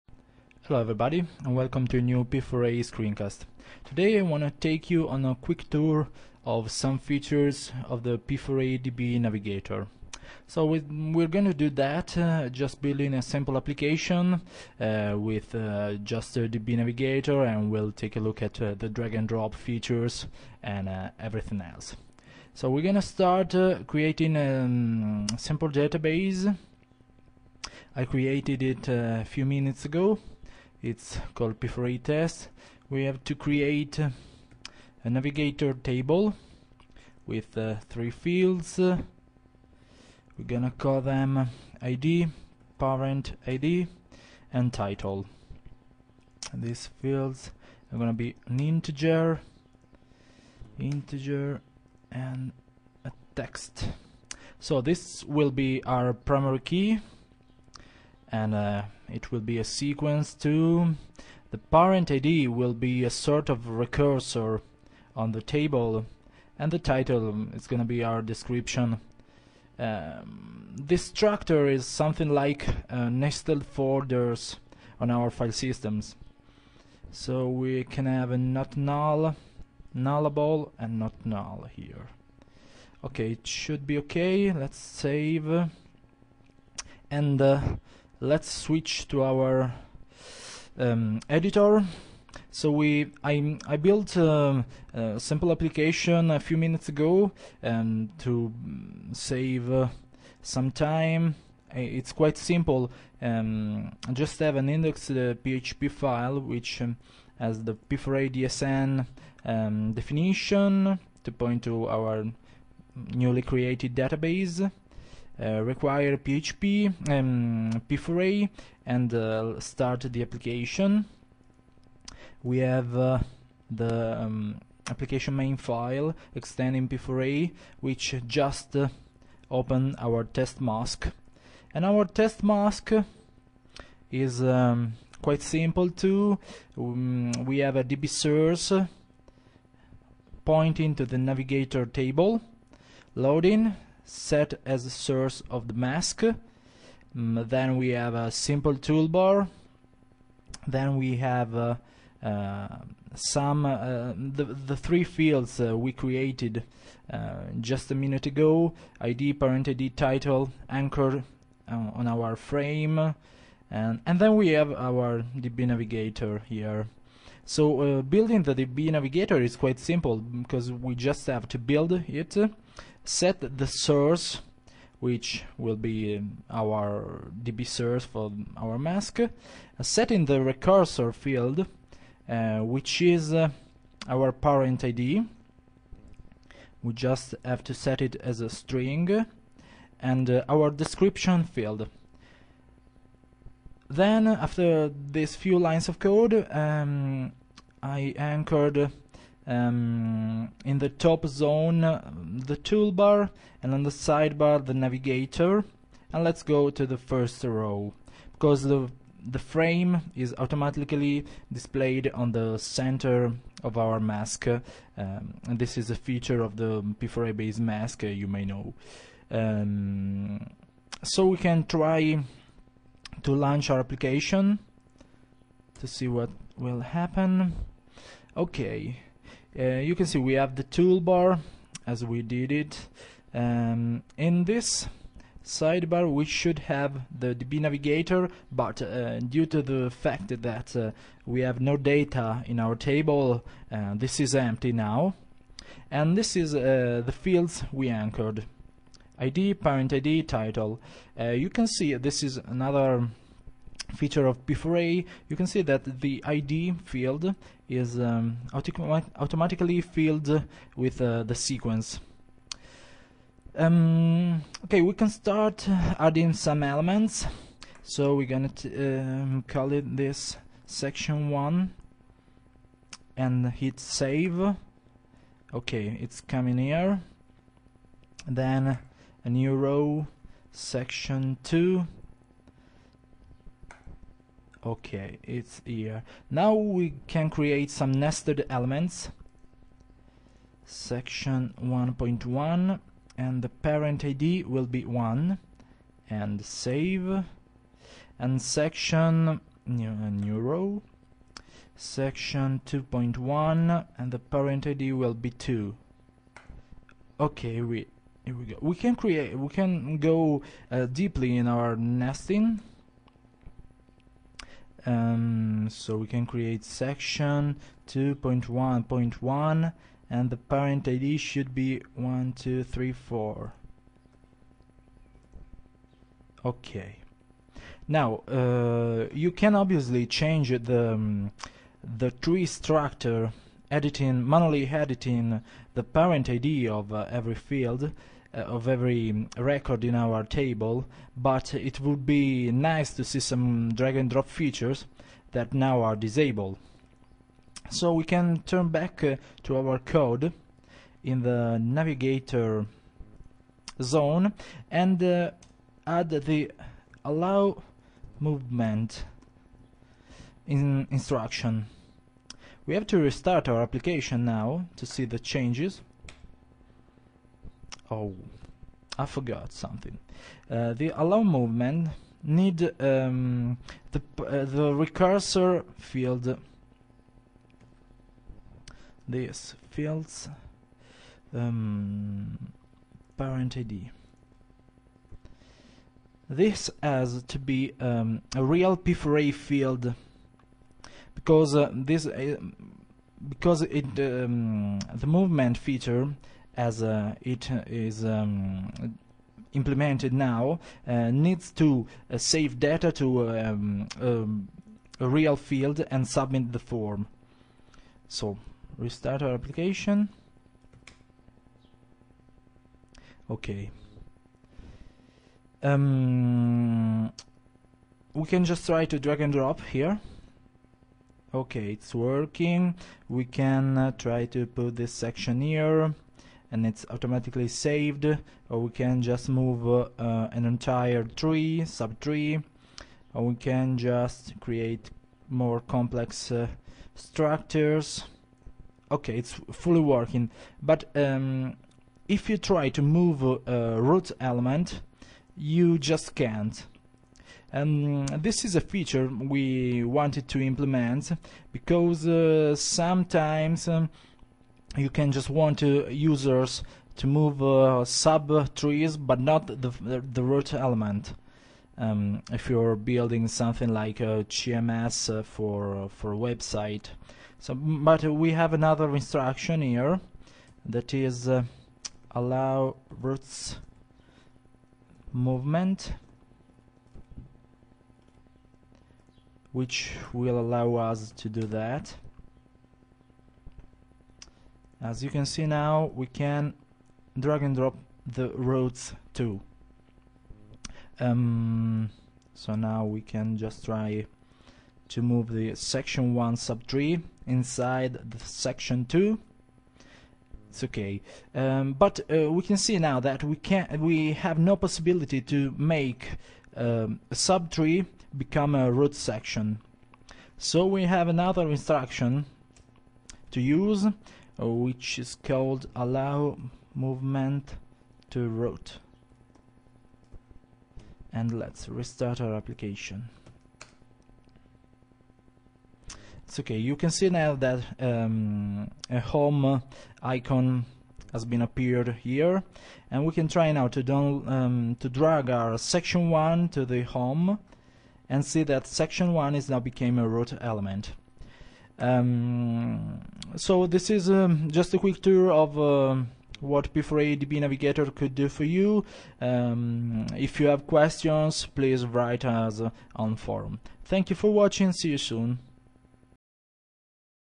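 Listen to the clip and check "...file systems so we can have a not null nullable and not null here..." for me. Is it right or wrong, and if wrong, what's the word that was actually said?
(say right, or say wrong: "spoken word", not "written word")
right.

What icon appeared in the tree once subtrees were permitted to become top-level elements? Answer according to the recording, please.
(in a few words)
home icon.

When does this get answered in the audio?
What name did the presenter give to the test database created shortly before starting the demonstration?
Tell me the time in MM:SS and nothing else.
00:31.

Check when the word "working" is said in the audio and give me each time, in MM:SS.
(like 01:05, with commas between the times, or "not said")
07:01, 07:19.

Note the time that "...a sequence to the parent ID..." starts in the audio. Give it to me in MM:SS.
00:59.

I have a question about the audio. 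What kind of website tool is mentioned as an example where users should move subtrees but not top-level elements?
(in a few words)
CMS.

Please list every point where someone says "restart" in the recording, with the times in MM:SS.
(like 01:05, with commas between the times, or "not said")
06:02, 06:48, 08:41.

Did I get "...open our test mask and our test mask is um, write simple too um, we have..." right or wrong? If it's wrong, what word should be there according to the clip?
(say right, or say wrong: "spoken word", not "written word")
wrong: "quite", not "write".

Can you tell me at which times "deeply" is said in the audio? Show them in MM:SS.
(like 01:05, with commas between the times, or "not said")
05:10.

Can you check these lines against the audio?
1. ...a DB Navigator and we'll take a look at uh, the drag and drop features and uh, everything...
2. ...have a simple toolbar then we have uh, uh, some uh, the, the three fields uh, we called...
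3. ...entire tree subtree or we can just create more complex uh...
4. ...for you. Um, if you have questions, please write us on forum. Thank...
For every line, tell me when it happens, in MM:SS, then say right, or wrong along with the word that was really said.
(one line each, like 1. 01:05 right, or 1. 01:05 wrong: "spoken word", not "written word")
1. 00:16 right
2. 02:27 wrong: "created", not "called"
3. 07:10 right
4. 09:08 right.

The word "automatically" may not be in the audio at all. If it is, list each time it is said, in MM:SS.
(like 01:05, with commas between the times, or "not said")
03:30, 04:18, 07:06.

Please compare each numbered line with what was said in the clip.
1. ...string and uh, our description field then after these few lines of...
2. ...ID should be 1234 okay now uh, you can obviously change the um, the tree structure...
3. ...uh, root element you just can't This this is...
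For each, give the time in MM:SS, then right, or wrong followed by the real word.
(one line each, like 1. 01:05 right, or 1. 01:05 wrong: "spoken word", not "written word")
1. 03:08 right
2. 05:20 right
3. 07:23 wrong: "And", not "This".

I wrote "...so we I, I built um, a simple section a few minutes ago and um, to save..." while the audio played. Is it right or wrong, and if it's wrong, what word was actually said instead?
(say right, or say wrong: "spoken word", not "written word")
wrong: "application", not "section".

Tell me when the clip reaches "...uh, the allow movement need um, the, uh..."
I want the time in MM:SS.
06:10.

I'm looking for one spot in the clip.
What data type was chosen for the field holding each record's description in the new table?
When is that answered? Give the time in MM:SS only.
00:53.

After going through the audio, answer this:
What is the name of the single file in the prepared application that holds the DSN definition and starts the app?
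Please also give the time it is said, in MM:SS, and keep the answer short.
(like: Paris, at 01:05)
index.php, at 01:44.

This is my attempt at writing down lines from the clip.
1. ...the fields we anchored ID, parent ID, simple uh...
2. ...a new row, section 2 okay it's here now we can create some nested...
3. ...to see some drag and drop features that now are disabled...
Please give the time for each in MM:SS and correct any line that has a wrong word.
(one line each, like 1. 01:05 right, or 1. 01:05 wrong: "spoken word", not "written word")
1. 04:07 wrong: "title", not "simple"
2. 04:39 right
3. 05:42 right.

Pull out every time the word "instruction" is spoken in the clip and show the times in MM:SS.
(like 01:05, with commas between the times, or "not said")
06:00, 07:48, 08:31.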